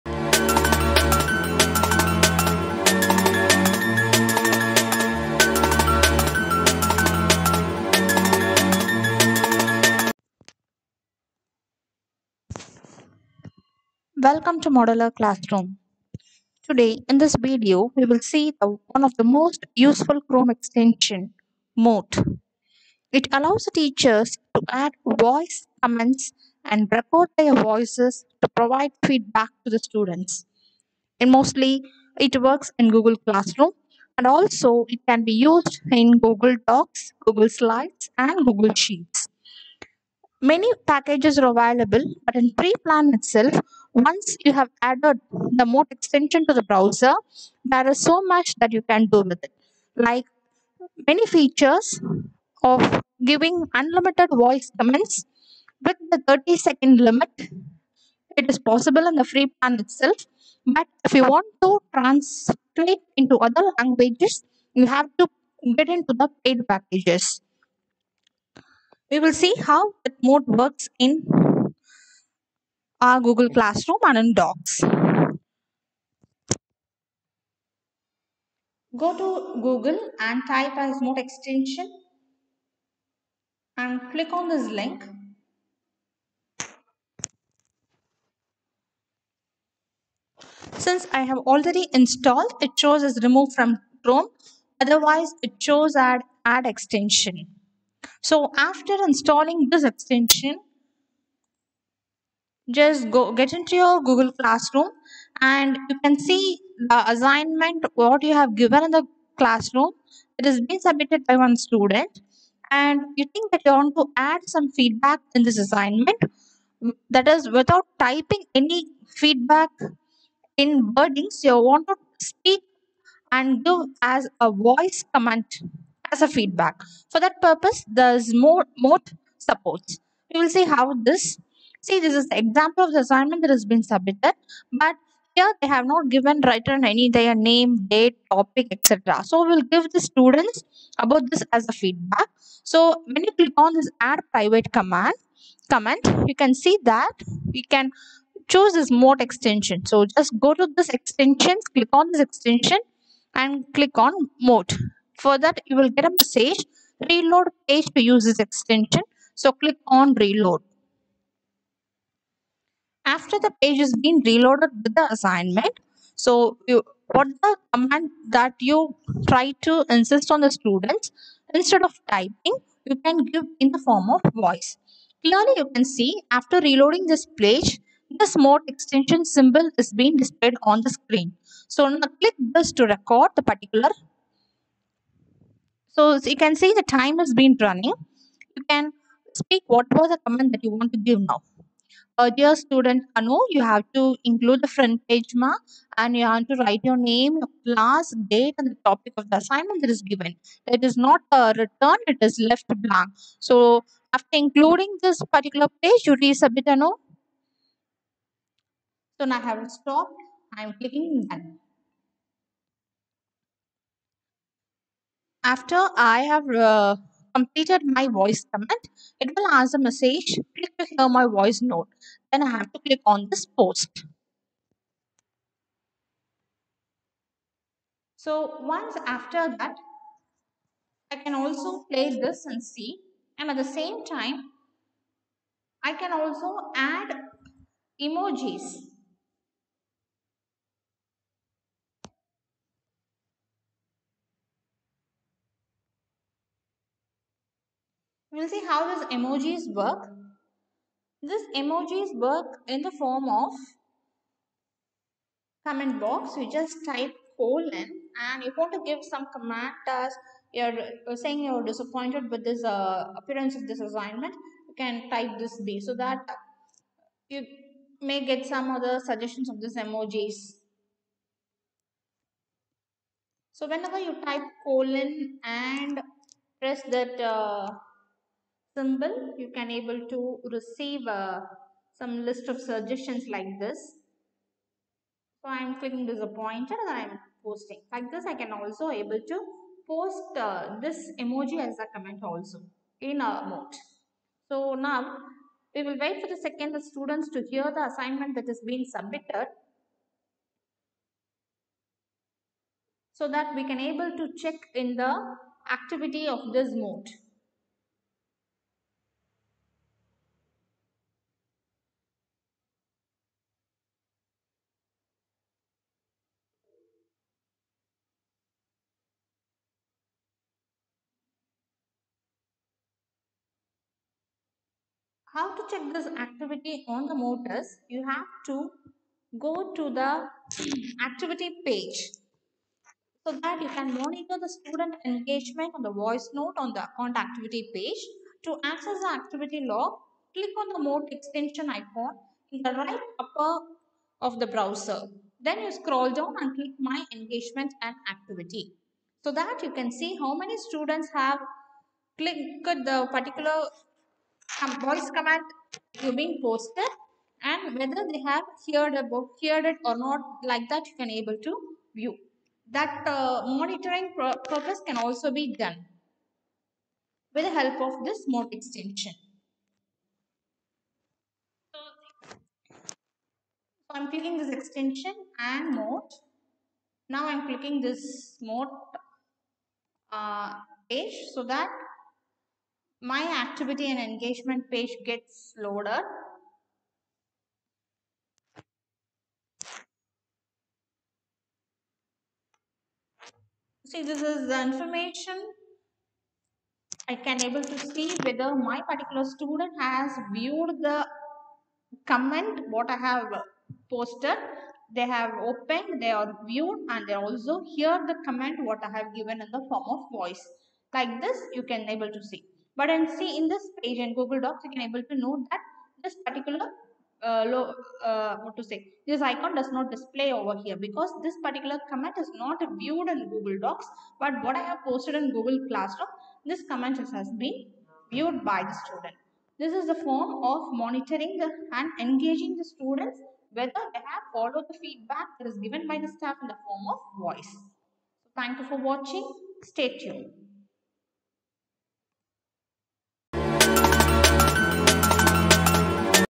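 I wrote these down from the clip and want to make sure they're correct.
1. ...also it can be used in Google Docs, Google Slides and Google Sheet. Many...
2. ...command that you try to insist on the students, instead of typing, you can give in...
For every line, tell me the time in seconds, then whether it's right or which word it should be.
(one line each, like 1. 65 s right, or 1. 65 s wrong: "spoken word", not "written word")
1. 34 s right
2. 167 s right.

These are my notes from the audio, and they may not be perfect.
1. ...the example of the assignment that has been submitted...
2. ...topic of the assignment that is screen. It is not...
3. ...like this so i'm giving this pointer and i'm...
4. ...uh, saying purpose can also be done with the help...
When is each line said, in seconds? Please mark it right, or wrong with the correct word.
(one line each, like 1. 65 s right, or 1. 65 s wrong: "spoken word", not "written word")
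1. 132 s right
2. 198 s wrong: "given", not "screen"
3. 283 s wrong: "clicking", not "giving"
4. 363 s wrong: "monitoring", not "saying".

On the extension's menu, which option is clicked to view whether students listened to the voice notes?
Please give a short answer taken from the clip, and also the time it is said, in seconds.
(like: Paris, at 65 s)
My engagement and activity, at 346 s.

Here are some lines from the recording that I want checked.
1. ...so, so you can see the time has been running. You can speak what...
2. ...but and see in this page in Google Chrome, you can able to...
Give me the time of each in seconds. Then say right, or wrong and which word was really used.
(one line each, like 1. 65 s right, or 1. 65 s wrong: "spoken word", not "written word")
1. 185 s right
2. 412 s wrong: "Docs", not "Chrome".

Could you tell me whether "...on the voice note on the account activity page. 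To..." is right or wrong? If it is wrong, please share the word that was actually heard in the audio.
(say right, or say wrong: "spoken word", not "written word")
right.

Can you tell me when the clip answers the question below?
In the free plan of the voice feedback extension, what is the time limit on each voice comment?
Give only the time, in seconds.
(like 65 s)
56 s.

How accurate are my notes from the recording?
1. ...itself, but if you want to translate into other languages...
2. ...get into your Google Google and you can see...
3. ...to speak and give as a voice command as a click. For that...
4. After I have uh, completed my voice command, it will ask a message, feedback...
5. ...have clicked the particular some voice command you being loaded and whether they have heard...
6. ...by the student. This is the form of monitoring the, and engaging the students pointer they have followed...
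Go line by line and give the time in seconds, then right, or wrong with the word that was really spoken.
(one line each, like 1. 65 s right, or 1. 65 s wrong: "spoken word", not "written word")
1. 59 s right
2. 103 s wrong: "Classroom", not "Google"
3. 121 s wrong: "feedback", not "click"
4. 215 s wrong: "click", not "feedback"
5. 351 s wrong: "posted", not "loaded"
6. 428 s wrong: "whether", not "pointer".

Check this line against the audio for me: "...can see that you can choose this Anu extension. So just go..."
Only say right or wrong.
wrong.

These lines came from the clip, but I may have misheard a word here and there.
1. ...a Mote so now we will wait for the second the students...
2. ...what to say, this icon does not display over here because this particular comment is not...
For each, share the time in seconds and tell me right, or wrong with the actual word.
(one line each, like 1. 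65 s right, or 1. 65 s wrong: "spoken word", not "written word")
1. 293 s right
2. 418 s right.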